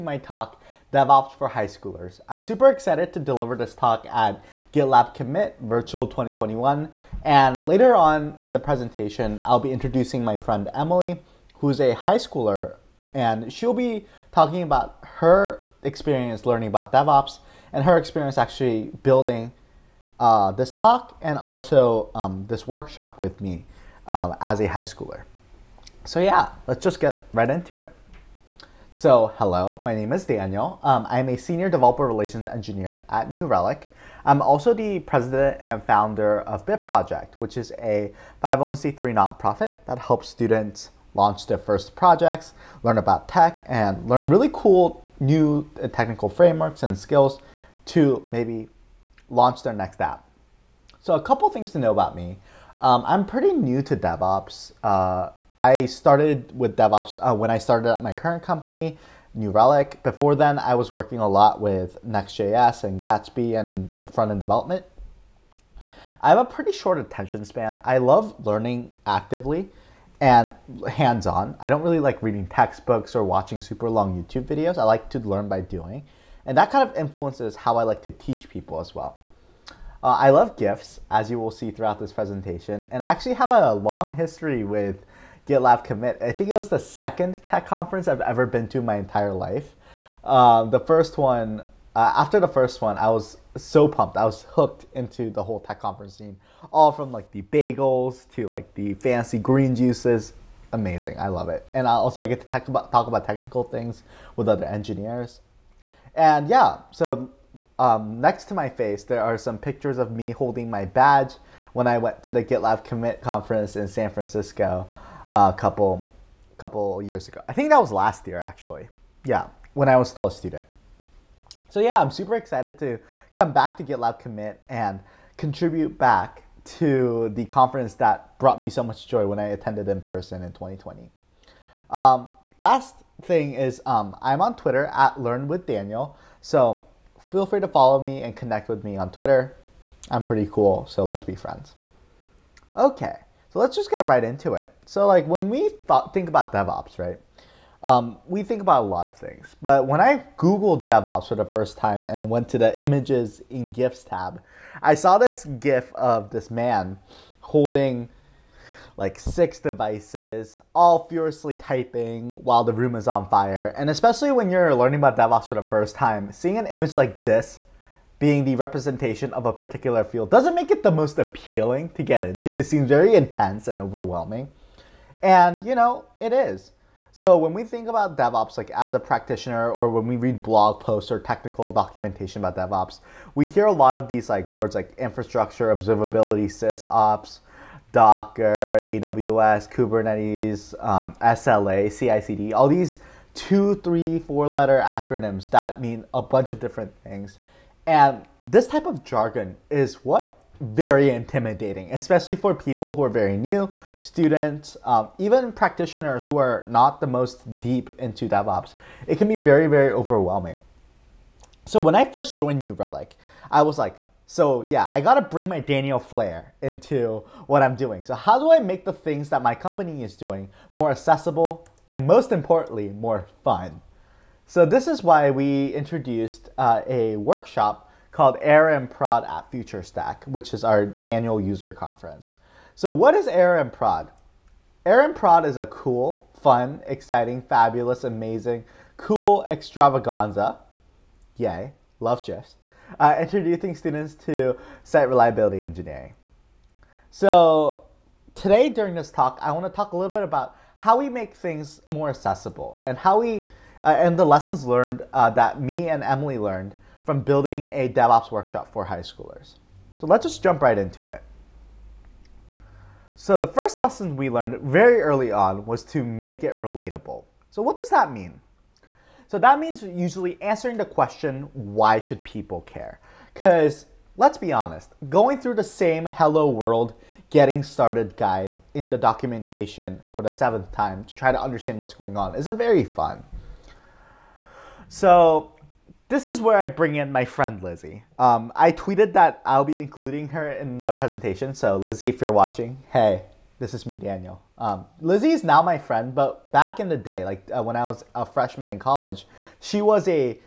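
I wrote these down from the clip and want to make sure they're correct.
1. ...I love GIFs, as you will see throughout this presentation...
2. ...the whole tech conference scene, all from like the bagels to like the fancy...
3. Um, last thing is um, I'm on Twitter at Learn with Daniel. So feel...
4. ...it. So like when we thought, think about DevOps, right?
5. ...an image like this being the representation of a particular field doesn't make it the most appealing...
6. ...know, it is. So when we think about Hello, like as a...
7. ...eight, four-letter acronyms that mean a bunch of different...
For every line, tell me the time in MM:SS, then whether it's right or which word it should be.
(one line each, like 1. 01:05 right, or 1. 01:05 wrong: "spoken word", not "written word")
1. 01:20 right
2. 01:35 right
3. 02:11 right
4. 02:24 right
5. 02:46 right
6. 02:55 wrong: "DevOps", not "Hello"
7. 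03:13 wrong: "three", not "eight".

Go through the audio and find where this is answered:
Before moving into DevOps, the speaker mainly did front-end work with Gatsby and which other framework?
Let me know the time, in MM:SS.
01:02.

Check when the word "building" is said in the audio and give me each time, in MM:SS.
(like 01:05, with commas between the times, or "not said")
00:19, 04:17.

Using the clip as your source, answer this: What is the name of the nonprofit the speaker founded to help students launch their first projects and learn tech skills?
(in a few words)
Bit Project.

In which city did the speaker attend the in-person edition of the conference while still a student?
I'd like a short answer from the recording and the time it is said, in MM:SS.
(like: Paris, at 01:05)
San Francisco, at 01:53.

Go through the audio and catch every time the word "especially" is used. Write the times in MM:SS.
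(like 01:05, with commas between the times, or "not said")
02:43, 03:21.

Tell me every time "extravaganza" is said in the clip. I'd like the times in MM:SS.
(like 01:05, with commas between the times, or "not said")
03:59.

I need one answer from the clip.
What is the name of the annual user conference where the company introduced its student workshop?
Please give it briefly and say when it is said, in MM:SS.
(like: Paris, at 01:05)
FutureStack, at 03:49.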